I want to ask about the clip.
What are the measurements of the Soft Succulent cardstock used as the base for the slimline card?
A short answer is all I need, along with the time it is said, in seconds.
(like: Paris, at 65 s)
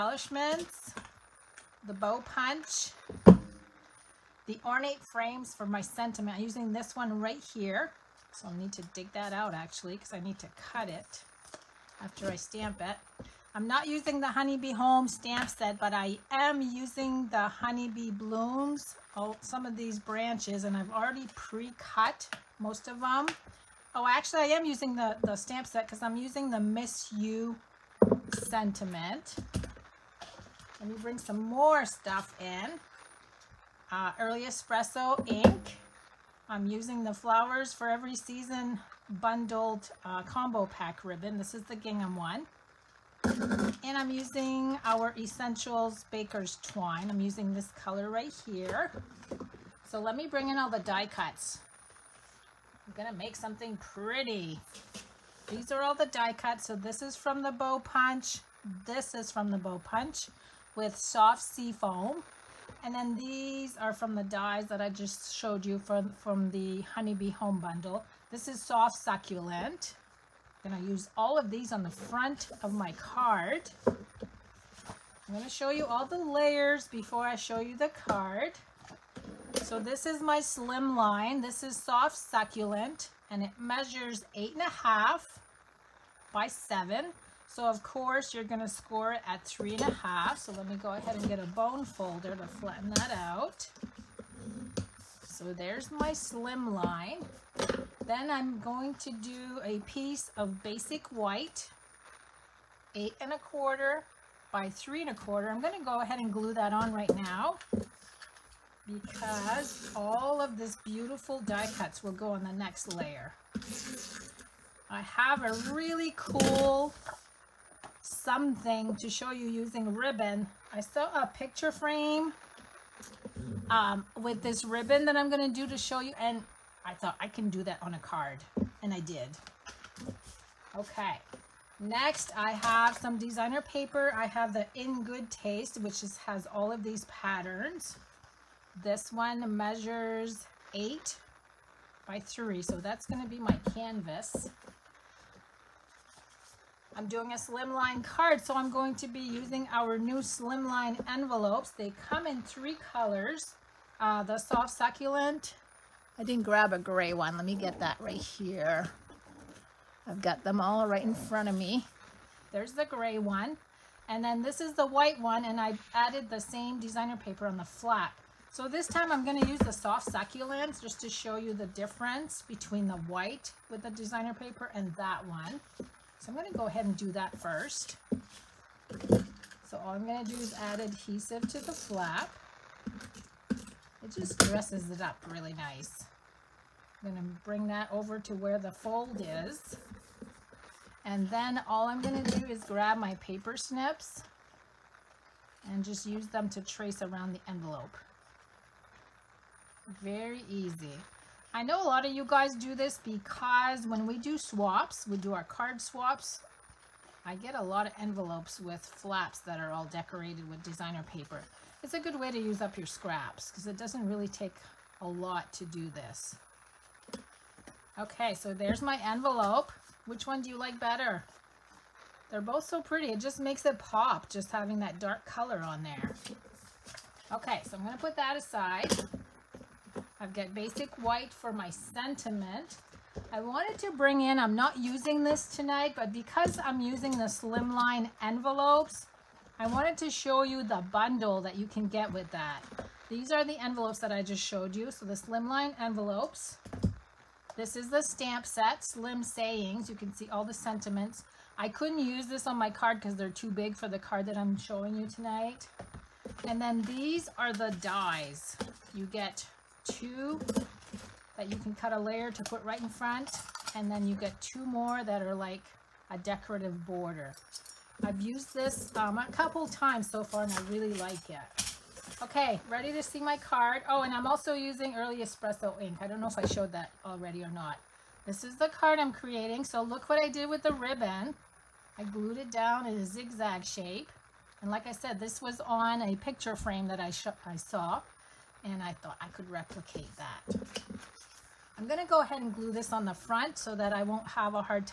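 8 1/2 by 7, at 84 s.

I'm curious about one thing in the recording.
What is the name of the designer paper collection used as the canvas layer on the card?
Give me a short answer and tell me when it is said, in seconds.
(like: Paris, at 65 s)
In Good Taste, at 134 s.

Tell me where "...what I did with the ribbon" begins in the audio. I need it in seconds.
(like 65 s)
280 s.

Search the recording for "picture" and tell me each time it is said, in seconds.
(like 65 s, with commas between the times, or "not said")
121 s, 286 s.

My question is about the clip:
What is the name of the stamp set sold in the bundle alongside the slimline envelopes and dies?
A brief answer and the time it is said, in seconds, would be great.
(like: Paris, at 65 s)
Slim Sayings, at 248 s.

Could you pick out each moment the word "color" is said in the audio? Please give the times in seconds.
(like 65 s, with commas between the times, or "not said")
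47 s, 152 s, 225 s.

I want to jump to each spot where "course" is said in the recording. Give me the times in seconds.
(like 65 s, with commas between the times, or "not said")
87 s.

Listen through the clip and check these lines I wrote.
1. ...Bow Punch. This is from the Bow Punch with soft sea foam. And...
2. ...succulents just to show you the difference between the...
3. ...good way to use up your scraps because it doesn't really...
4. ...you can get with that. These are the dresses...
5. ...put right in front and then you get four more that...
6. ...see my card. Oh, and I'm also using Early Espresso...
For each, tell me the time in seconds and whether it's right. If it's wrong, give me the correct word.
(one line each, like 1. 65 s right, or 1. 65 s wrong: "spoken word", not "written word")
1. 57 s right
2. 170 s right
3. 211 s right
4. 241 s wrong: "envelopes", not "dresses"
5. 262 s wrong: "two", not "four"
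6. 273 s right.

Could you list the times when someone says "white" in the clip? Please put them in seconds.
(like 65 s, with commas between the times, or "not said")
101 s, 164 s, 172 s, 231 s.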